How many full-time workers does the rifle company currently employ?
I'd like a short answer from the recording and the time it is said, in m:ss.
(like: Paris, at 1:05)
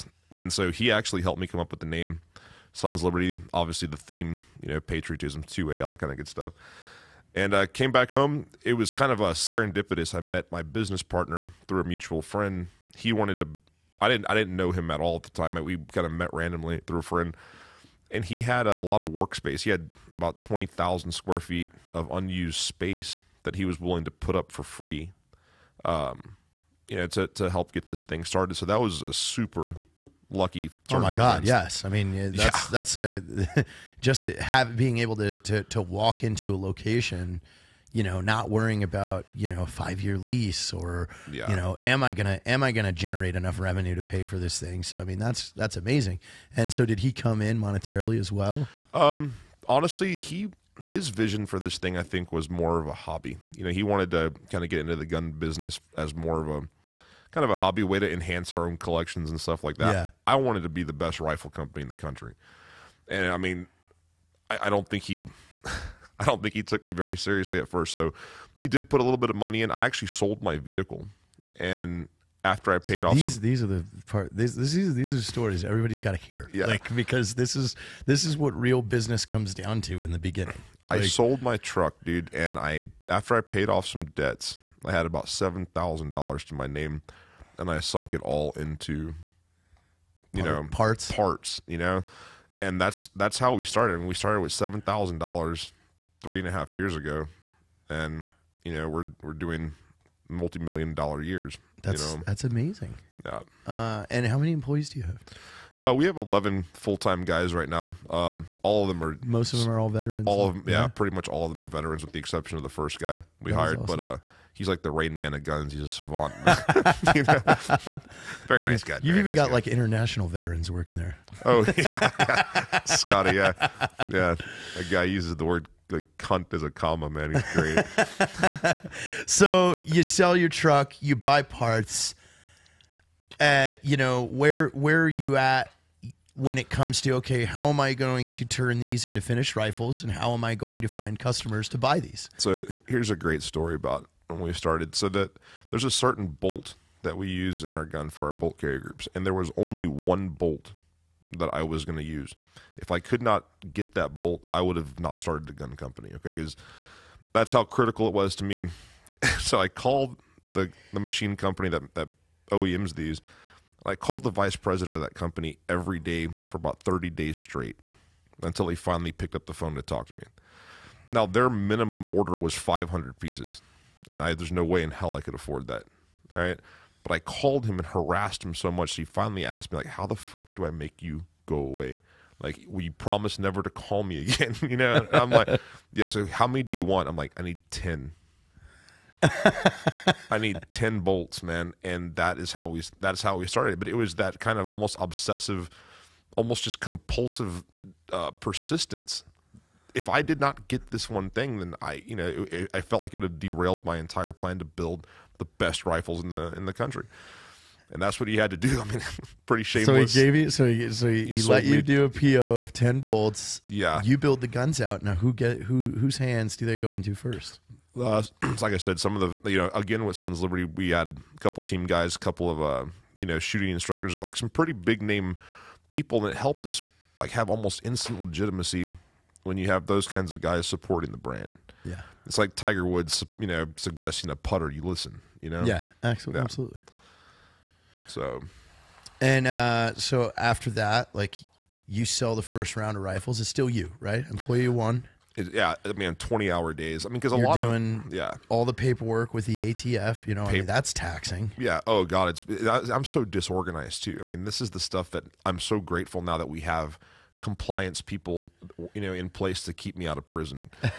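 11, at 1:46.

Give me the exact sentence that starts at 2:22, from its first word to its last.
So here's a great story about when we started.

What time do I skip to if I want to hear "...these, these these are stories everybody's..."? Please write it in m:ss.
1:14.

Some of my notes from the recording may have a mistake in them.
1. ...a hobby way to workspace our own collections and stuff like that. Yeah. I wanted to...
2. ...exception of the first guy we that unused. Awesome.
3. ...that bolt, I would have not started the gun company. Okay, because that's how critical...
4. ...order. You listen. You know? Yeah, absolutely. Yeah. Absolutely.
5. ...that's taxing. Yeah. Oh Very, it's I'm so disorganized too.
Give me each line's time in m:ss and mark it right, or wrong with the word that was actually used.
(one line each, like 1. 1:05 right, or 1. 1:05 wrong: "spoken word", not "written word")
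1. 0:57 wrong: "enhance", not "workspace"
2. 1:52 wrong: "hired", not "unused"
3. 2:33 right
4. 3:54 wrong: "putter", not "order"
5. 4:10 wrong: "God", not "Very".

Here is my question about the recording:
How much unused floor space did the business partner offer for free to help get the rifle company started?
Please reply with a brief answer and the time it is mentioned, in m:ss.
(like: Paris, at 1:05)
20,000 square feet, at 0:20.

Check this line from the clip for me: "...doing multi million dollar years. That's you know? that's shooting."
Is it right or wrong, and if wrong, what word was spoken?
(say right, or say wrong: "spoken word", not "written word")
wrong: "amazing", not "shooting".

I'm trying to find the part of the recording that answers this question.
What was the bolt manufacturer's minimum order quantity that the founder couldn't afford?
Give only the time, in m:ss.
2:52.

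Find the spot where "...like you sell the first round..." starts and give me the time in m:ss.
4:01.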